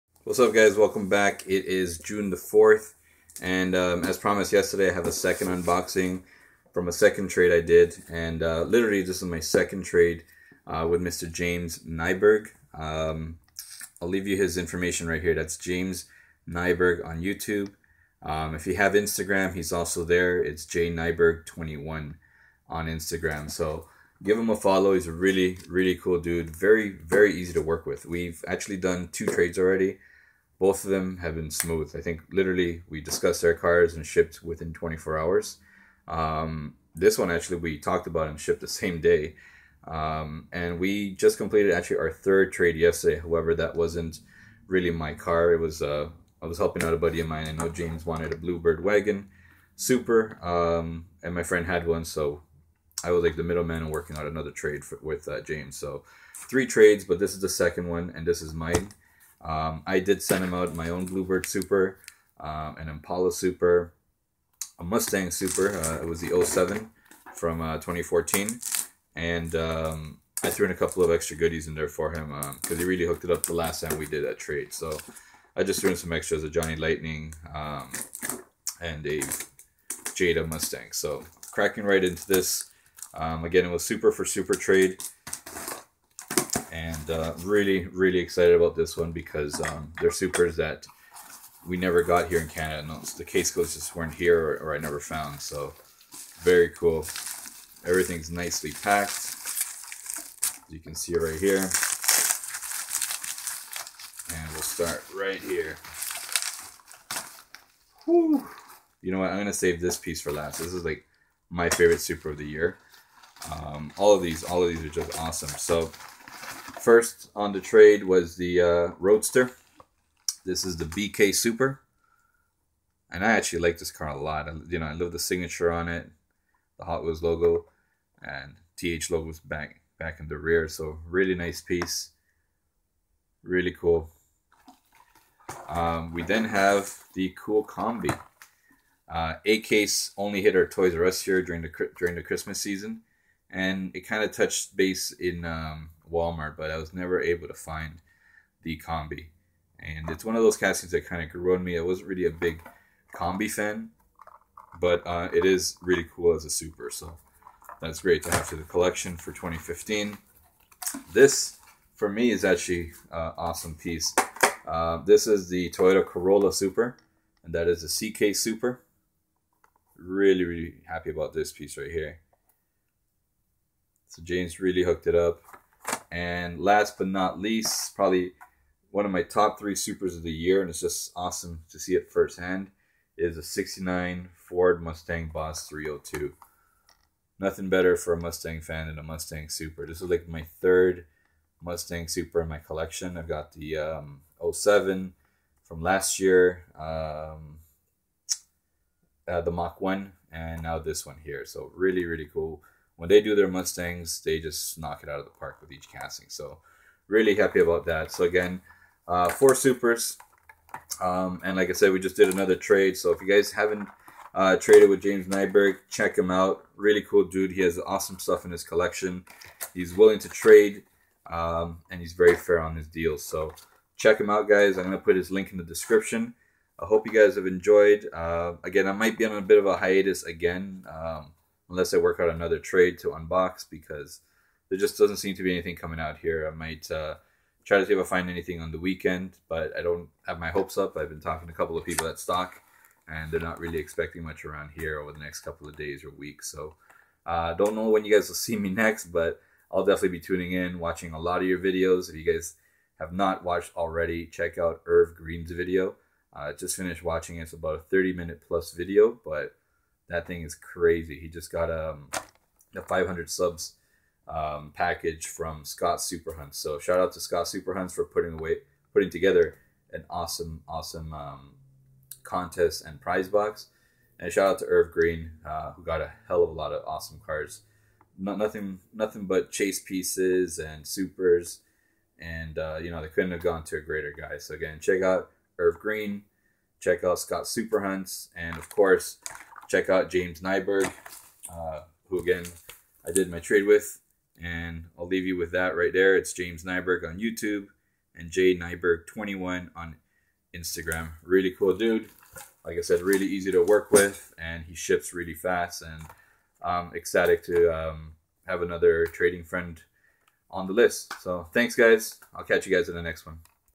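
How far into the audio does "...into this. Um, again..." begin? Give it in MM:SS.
01:22.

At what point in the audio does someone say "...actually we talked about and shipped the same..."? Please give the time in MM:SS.
00:37.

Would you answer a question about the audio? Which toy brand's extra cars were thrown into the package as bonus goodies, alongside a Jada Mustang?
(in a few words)
Johnny Lightning.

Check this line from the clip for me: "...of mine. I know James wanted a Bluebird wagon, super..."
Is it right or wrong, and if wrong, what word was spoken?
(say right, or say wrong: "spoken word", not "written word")
right.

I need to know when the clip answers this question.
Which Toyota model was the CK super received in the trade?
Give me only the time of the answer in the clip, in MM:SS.
02:46.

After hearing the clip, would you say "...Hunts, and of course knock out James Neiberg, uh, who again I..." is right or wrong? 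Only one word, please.
wrong.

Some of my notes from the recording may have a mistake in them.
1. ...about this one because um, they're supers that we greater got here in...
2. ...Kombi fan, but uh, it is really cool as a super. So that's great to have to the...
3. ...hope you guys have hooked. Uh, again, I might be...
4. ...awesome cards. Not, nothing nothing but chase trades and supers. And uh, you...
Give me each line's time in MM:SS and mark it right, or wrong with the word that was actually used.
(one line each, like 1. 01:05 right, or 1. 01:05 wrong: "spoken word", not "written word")
1. 01:28 wrong: "never", not "greater"
2. 02:33 right
3. 03:46 wrong: "enjoyed", not "hooked"
4. 04:36 wrong: "pieces", not "trades".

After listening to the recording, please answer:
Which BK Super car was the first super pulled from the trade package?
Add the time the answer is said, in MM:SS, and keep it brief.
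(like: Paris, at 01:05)
Rrroadster, at 01:58.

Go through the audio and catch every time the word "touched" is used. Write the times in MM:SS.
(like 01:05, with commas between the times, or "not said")
02:24.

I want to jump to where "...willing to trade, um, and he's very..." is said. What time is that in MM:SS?
03:39.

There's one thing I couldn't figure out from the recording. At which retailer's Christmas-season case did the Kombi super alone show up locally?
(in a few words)
Toys R Us.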